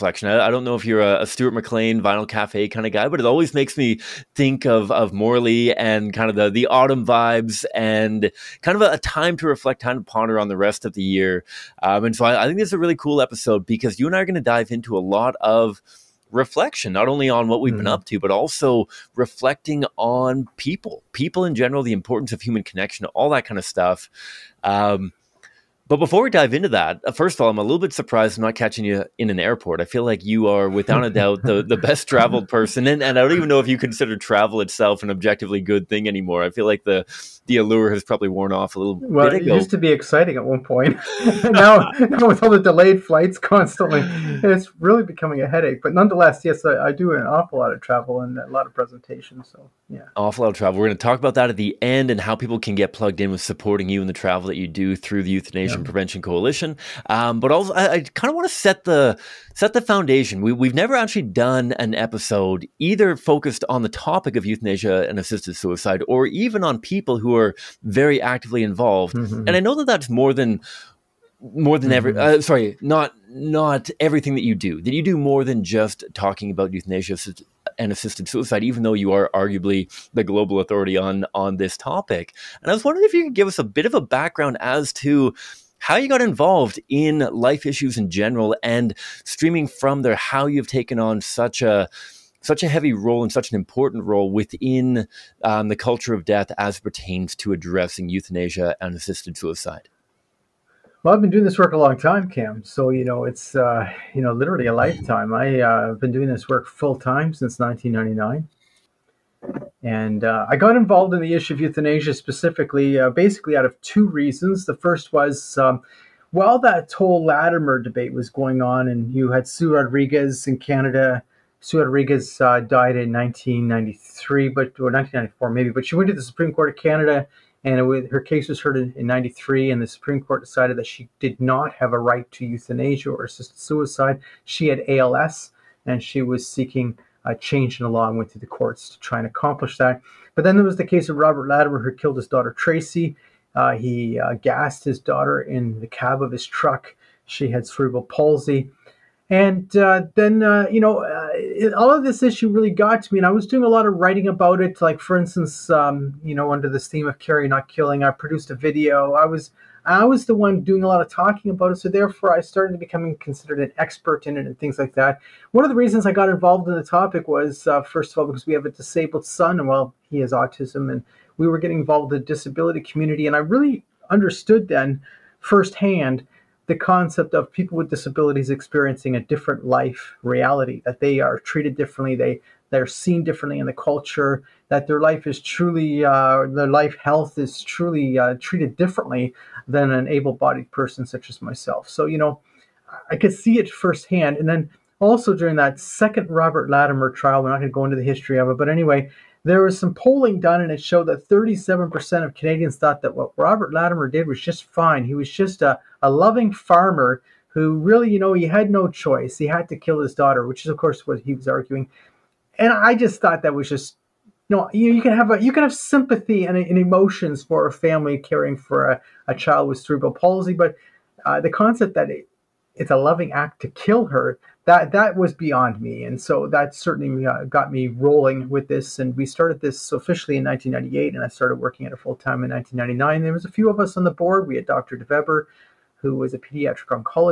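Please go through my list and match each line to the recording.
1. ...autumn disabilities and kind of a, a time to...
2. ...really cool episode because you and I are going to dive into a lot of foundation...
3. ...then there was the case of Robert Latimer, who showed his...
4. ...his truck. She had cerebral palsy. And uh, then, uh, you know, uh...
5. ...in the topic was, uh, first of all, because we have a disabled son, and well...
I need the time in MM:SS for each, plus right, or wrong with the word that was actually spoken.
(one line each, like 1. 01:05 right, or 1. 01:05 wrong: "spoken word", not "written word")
1. 00:06 wrong: "vibes", not "disabilities"
2. 00:12 wrong: "reflection", not "foundation"
3. 02:20 wrong: "killed", not "showed"
4. 02:26 right
5. 02:46 right.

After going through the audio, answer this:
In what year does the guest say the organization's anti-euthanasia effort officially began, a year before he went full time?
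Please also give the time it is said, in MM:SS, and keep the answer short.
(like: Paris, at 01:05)
1998, at 03:50.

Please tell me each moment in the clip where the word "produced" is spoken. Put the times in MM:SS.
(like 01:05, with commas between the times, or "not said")
02:38.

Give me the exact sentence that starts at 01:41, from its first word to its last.
Well, I've been doing this work a long time, Cam.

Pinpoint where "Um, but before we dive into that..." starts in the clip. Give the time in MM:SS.
00:24.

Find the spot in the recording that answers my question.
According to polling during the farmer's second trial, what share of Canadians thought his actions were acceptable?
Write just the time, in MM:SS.
03:21.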